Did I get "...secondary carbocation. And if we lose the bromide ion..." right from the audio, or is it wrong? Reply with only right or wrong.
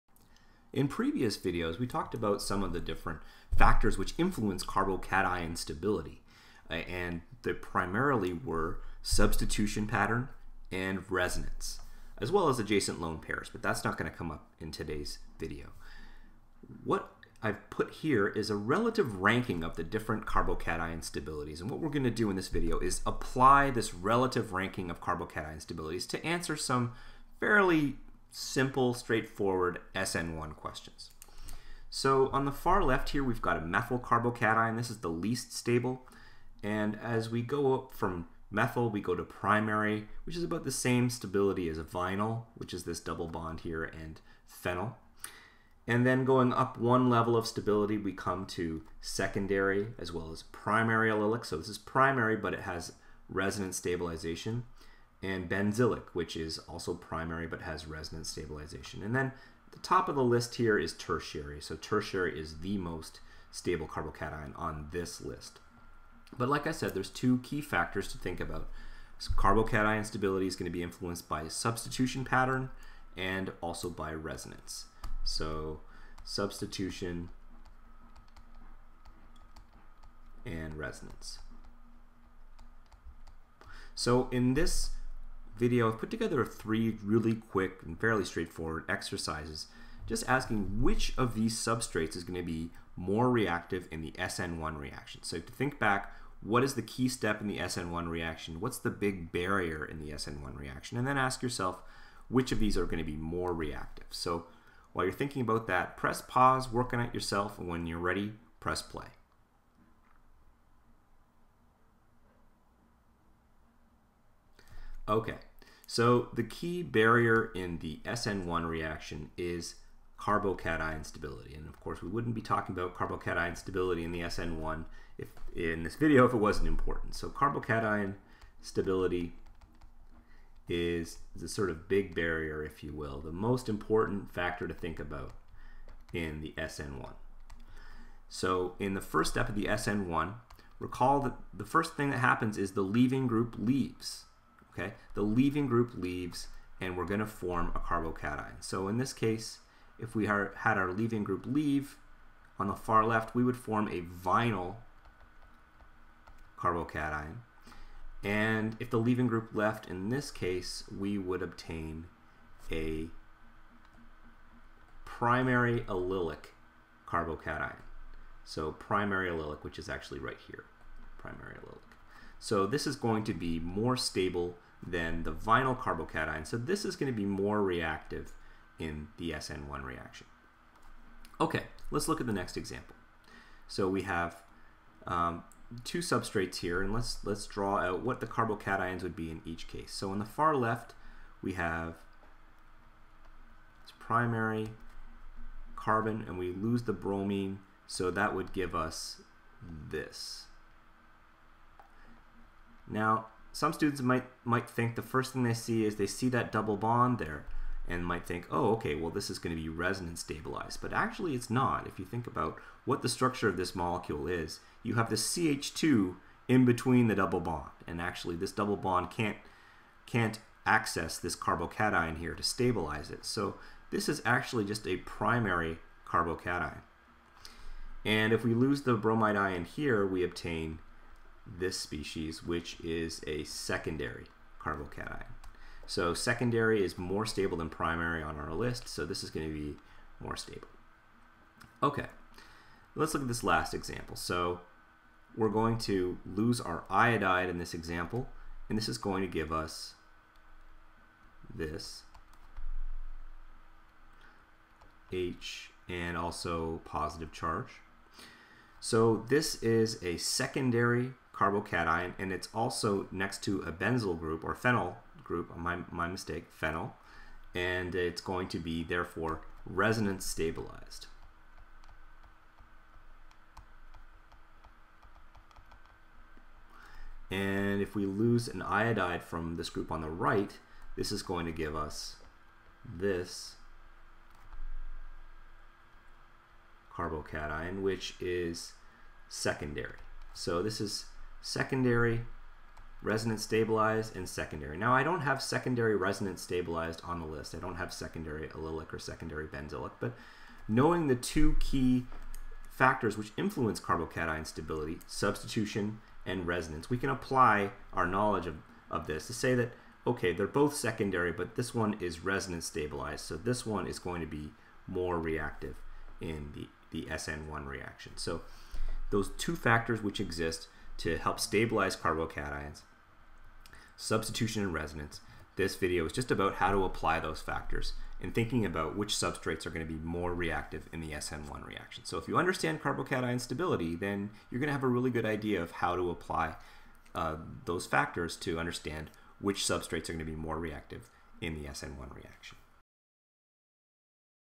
wrong.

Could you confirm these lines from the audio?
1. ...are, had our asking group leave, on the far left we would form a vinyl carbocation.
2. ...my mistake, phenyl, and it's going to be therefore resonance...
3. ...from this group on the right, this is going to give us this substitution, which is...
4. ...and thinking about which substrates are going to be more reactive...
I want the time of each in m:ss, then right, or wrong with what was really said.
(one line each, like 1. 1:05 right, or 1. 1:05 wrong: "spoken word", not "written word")
1. 2:30 wrong: "leaving", not "asking"
2. 4:25 right
3. 4:39 wrong: "carbocation", not "substitution"
4. 5:28 right.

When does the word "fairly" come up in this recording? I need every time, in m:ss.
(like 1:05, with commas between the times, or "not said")
0:27, 1:27.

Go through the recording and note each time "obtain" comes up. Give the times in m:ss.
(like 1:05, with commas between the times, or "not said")
2:41, 3:50.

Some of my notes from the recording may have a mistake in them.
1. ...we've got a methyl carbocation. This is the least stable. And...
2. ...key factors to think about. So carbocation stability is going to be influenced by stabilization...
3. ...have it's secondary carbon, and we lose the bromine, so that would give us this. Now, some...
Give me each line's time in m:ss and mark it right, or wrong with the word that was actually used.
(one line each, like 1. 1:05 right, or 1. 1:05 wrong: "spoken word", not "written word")
1. 0:33 right
2. 1:07 wrong: "substitution", not "stabilization"
3. 3:11 wrong: "primary", not "secondary".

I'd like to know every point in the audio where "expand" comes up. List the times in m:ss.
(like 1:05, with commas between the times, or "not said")
not said.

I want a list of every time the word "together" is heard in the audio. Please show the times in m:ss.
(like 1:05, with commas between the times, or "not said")
1:26.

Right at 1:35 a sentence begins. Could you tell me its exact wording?
So to think back, what is the key step in the SN1 reaction?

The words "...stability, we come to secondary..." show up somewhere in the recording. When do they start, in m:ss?
0:47.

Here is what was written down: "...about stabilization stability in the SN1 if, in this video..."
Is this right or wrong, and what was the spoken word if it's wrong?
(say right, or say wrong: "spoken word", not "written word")
wrong: "carbocation", not "stabilization".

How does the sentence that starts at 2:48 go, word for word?
So primary allylic, which is actually right here, primary allylic.